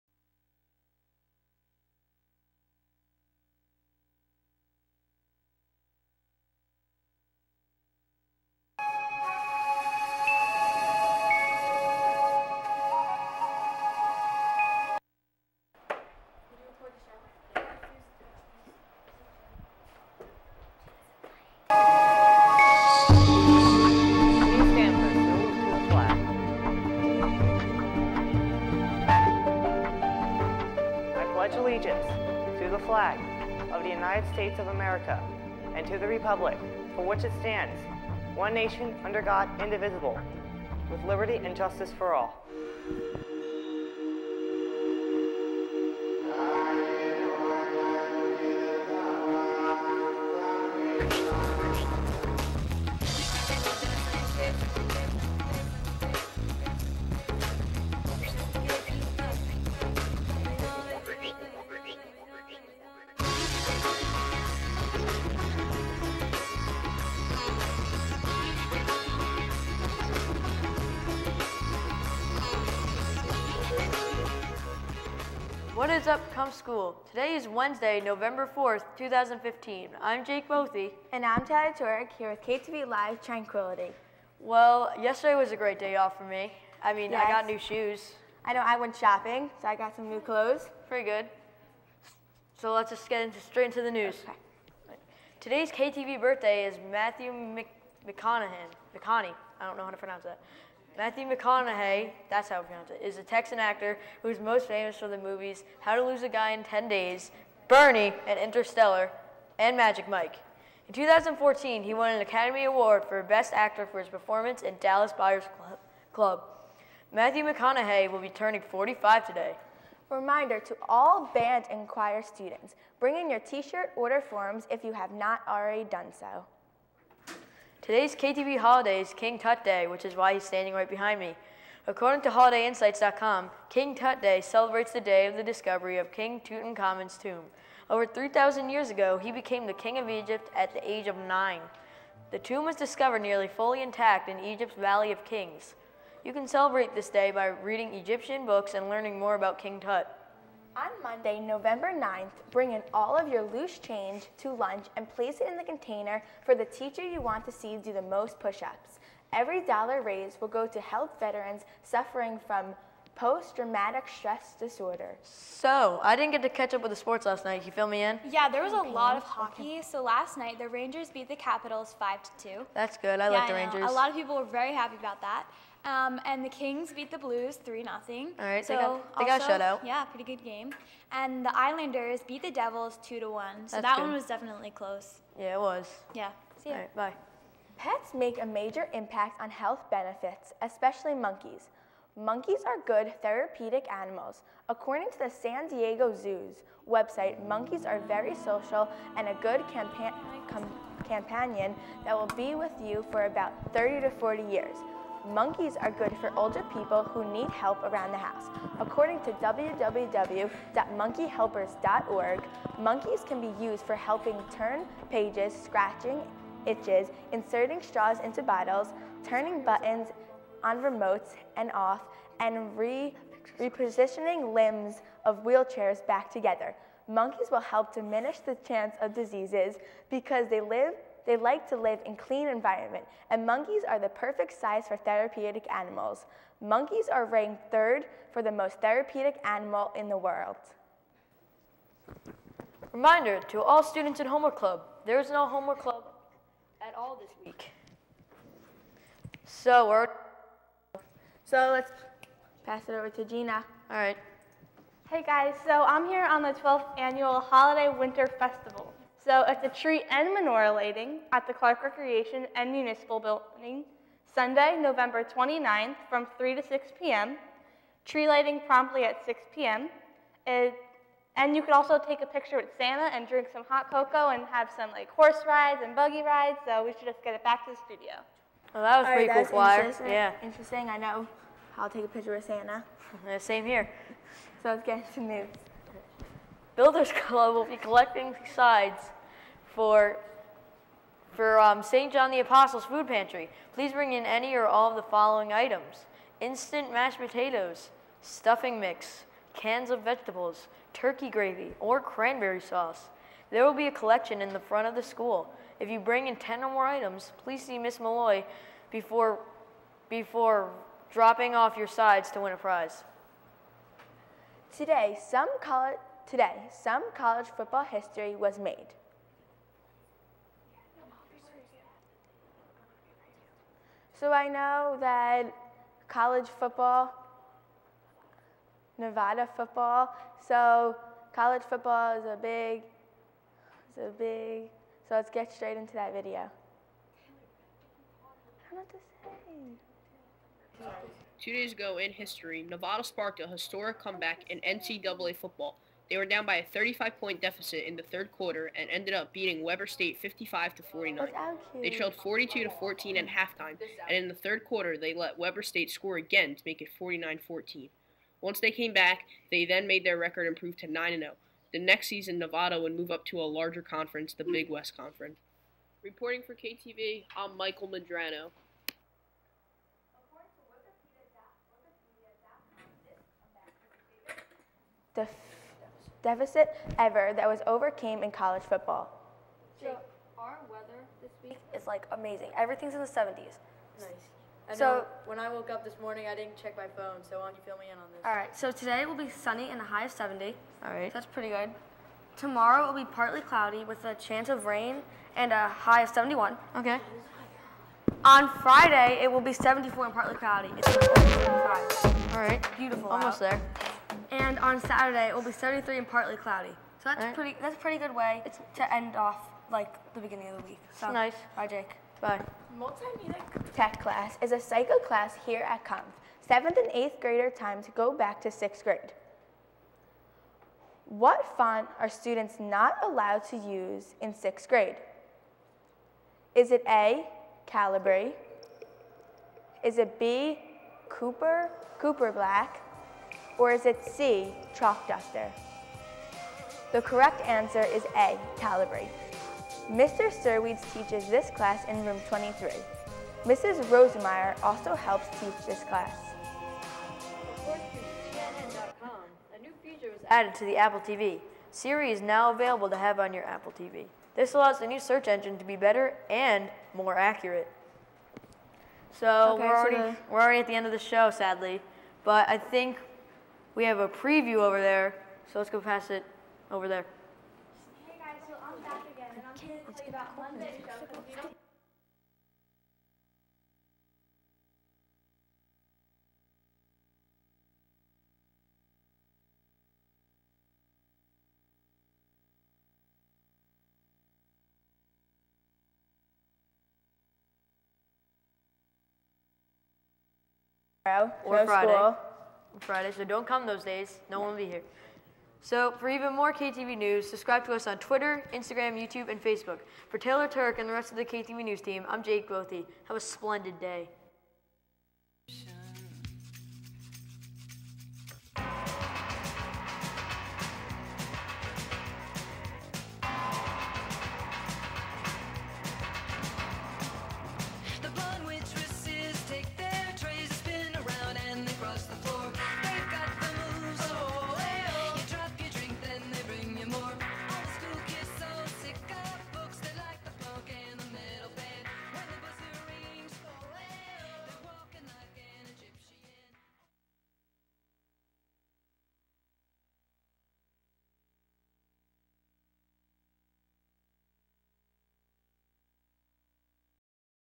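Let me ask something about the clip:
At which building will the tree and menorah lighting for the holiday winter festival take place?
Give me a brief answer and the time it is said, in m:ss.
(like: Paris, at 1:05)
Clark Recreation and Municipal Building, at 4:21.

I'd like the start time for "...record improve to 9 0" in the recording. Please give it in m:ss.
6:00.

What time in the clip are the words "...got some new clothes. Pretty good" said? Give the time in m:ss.
1:29.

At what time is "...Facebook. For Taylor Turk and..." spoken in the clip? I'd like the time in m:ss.
8:19.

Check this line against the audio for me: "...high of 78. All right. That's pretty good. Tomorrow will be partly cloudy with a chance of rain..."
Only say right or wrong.
wrong.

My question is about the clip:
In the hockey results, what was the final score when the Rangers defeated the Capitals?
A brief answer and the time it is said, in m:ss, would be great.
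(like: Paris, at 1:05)
5 to 2, at 2:51.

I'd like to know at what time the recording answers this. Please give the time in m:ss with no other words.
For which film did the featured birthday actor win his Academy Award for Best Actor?
1:54.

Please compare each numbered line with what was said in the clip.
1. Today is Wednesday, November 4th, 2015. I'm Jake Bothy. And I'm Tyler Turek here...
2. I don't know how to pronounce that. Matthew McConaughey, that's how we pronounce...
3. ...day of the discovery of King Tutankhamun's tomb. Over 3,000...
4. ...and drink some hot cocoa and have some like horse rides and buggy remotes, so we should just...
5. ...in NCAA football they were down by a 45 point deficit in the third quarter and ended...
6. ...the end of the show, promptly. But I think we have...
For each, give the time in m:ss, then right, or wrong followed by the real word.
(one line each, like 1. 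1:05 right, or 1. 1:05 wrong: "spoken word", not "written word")
1. 1:17 right
2. 1:39 right
3. 2:15 right
4. 4:33 wrong: "rides", not "remotes"
5. 5:44 wrong: "35", not "45"
6. 7:40 wrong: "sadly", not "promptly".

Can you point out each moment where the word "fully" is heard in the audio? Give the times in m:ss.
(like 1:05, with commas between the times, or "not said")
2:23.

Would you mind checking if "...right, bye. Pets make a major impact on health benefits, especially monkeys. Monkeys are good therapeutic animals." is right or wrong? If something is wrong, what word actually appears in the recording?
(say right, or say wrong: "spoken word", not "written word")
right.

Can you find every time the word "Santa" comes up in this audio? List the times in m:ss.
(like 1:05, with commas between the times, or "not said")
4:32, 4:42.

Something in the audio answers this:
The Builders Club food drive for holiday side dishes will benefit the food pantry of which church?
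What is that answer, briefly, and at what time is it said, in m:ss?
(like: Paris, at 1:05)
St. John the Apostle, at 4:51.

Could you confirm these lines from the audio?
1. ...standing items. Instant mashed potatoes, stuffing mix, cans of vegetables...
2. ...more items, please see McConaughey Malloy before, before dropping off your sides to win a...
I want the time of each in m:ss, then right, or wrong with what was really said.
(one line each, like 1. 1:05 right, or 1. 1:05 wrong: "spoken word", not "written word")
1. 4:55 wrong: "following", not "standing"
2. 5:06 wrong: "Miss", not "McConaughey".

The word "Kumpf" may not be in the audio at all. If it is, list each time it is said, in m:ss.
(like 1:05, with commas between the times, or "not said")
1:16, 6:55.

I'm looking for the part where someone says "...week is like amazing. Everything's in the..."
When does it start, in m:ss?
6:21.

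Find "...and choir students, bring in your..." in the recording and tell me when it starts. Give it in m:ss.
2:01.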